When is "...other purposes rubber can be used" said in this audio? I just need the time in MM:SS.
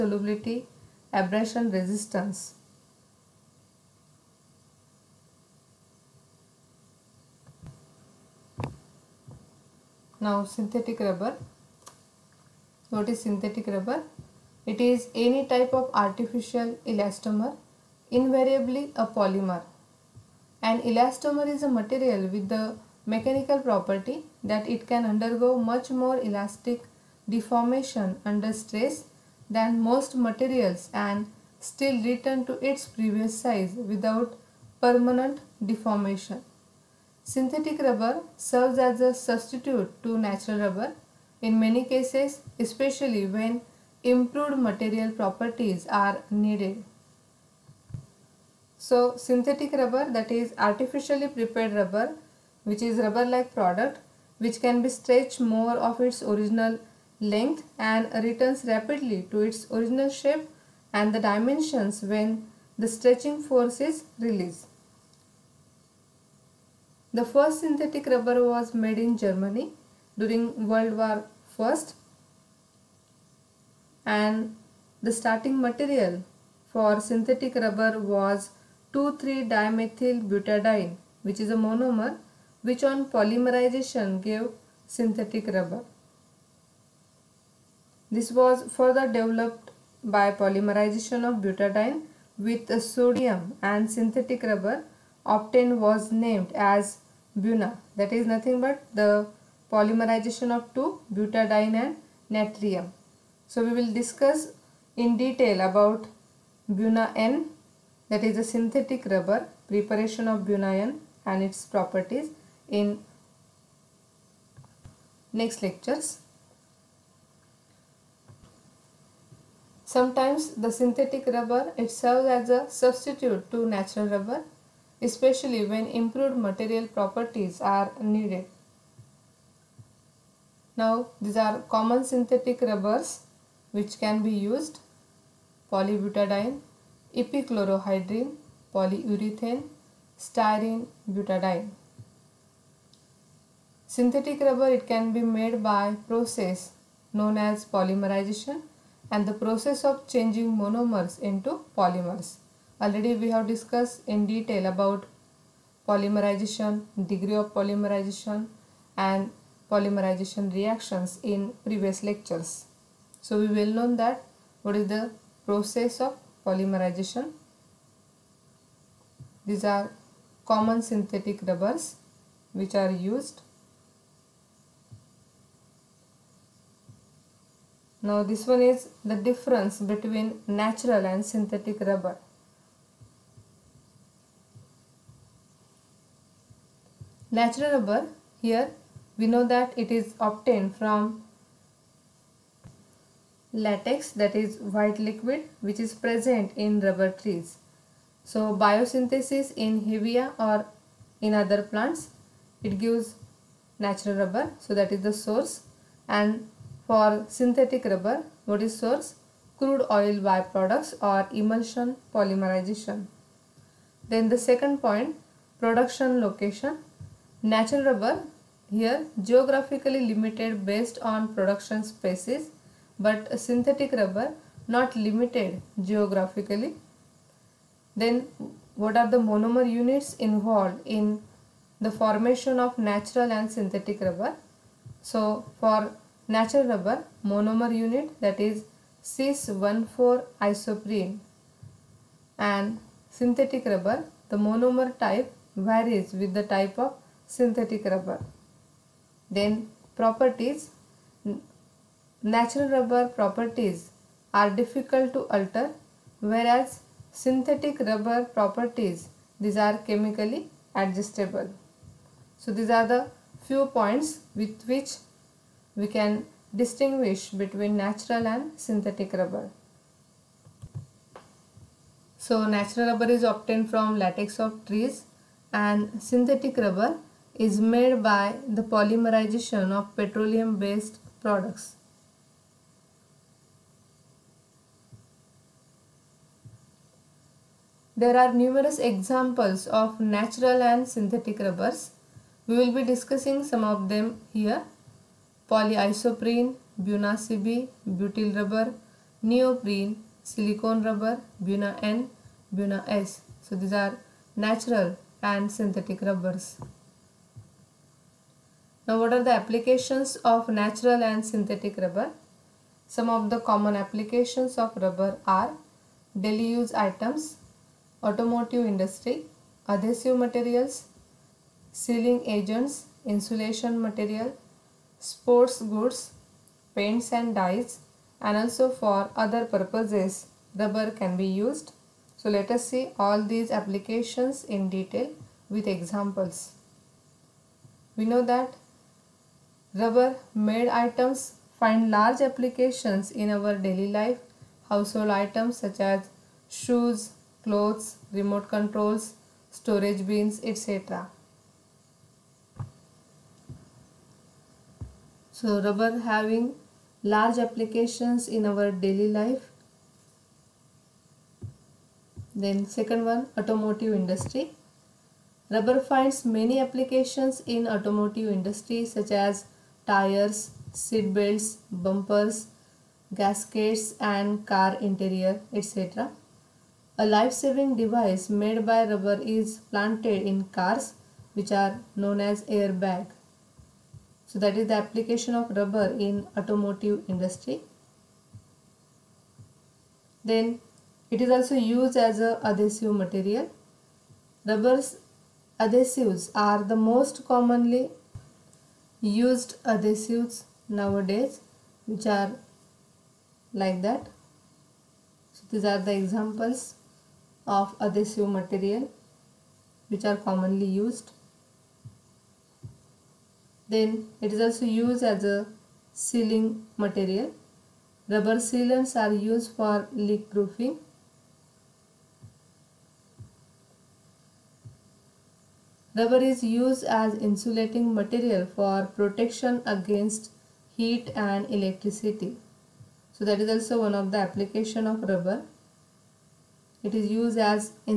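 05:29.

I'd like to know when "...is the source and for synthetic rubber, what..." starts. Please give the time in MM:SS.
03:24.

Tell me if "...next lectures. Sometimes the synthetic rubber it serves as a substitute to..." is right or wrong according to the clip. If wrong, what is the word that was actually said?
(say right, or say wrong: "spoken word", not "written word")
right.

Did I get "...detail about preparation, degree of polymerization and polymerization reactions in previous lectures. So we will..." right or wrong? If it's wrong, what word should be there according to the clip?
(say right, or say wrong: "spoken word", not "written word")
wrong: "polymerization", not "preparation".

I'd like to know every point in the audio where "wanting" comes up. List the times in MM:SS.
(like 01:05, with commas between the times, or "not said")
not said.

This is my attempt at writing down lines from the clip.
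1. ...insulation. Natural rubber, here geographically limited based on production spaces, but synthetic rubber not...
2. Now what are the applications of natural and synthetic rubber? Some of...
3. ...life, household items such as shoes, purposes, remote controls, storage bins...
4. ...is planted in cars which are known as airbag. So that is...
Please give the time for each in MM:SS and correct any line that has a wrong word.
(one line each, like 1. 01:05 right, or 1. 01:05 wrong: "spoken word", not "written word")
1. 03:36 wrong: "location", not "insulation"
2. 05:08 right
3. 05:43 wrong: "clothes", not "purposes"
4. 06:19 right.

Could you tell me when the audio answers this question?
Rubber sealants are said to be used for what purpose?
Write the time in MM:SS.
06:59.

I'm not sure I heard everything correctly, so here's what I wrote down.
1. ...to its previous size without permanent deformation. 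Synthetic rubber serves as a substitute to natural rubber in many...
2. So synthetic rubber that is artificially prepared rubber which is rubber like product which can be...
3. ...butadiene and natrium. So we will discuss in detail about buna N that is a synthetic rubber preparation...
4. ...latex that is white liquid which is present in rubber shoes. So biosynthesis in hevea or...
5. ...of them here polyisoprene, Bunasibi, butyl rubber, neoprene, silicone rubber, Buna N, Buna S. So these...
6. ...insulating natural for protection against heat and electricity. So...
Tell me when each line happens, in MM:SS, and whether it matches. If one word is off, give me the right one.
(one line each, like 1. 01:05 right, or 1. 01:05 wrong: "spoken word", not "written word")
1. 00:32 right
2. 00:48 right
3. 01:41 right
4. 03:13 wrong: "trees", not "shoes"
5. 04:53 right
6. 07:07 wrong: "material", not "natural".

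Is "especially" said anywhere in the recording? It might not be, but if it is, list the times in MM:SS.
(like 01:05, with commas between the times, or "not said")
00:42, 02:05.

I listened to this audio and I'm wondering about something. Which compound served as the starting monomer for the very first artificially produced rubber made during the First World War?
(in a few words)
2,3-dimethylbutadiene.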